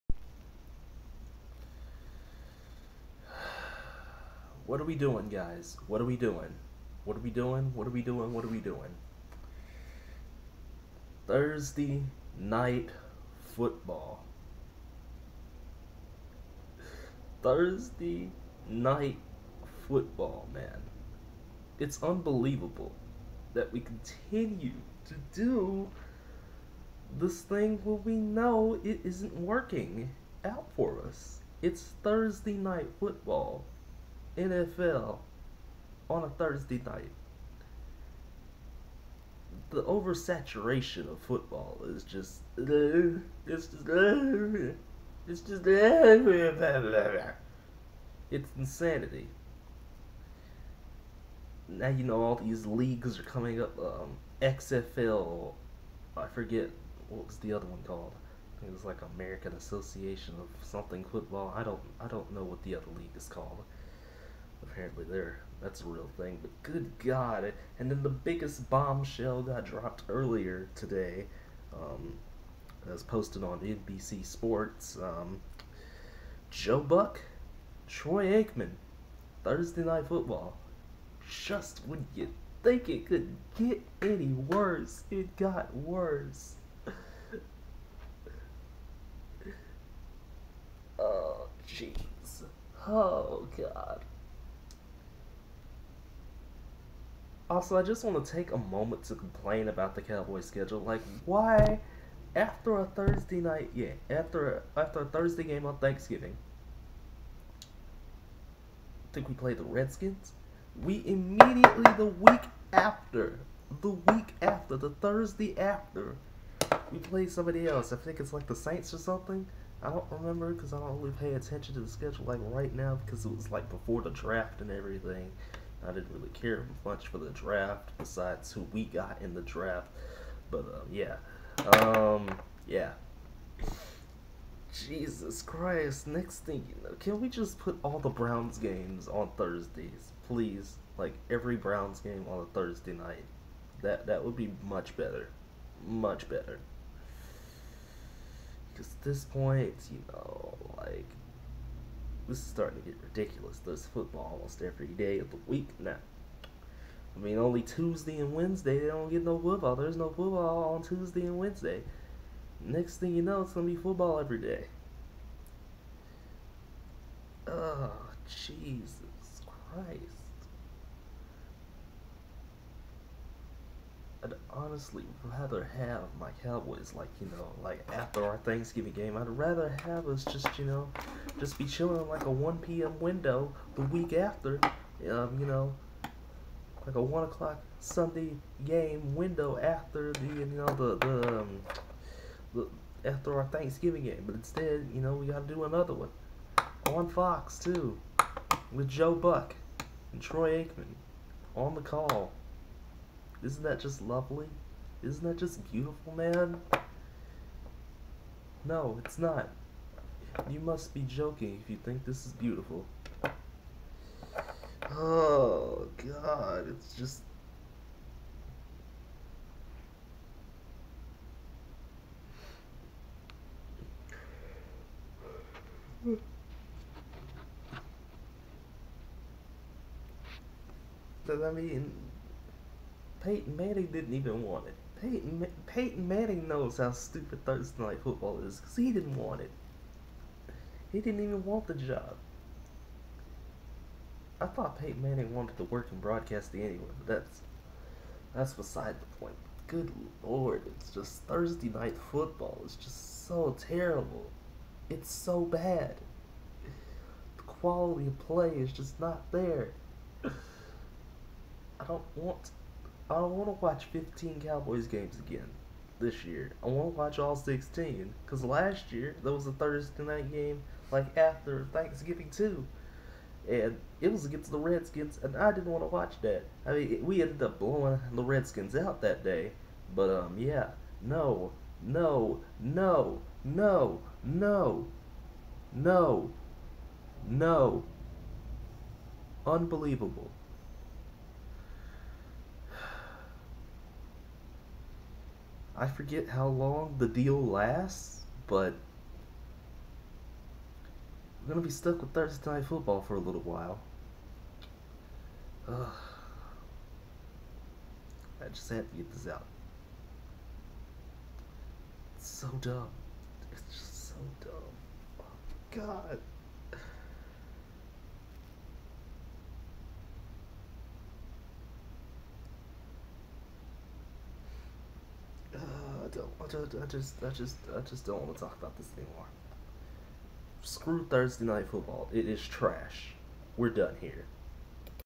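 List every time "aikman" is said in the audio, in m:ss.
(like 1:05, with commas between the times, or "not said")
1:18, 3:20.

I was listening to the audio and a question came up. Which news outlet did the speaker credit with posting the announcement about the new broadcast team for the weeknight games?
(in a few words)
NBC Sports.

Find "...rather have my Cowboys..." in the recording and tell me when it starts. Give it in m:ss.
2:55.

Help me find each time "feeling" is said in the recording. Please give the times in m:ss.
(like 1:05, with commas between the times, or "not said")
not said.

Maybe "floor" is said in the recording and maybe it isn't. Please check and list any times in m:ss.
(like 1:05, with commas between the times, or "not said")
not said.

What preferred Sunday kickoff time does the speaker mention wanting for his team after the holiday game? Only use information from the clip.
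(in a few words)
1 p.m.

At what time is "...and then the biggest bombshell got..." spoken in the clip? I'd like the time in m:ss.
1:07.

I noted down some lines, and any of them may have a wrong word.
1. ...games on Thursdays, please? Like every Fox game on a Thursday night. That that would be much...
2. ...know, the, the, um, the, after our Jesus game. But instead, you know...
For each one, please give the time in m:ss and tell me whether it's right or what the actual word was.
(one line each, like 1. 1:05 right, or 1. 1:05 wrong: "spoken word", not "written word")
1. 2:18 wrong: "Browns", not "Fox"
2. 3:10 wrong: "Thanksgiving", not "Jesus".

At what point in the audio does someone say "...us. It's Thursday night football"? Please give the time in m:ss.
0:31.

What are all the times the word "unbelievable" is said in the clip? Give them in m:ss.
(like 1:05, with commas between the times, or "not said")
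0:22, 4:49.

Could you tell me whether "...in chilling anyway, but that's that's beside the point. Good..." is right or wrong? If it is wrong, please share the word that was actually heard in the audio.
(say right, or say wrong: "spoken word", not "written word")
wrong: "broadcasting", not "chilling".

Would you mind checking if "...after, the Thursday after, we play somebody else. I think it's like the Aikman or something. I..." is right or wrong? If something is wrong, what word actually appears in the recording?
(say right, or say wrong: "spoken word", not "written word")
wrong: "Saints", not "Aikman".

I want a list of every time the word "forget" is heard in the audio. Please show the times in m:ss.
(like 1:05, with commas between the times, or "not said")
0:56, 4:55.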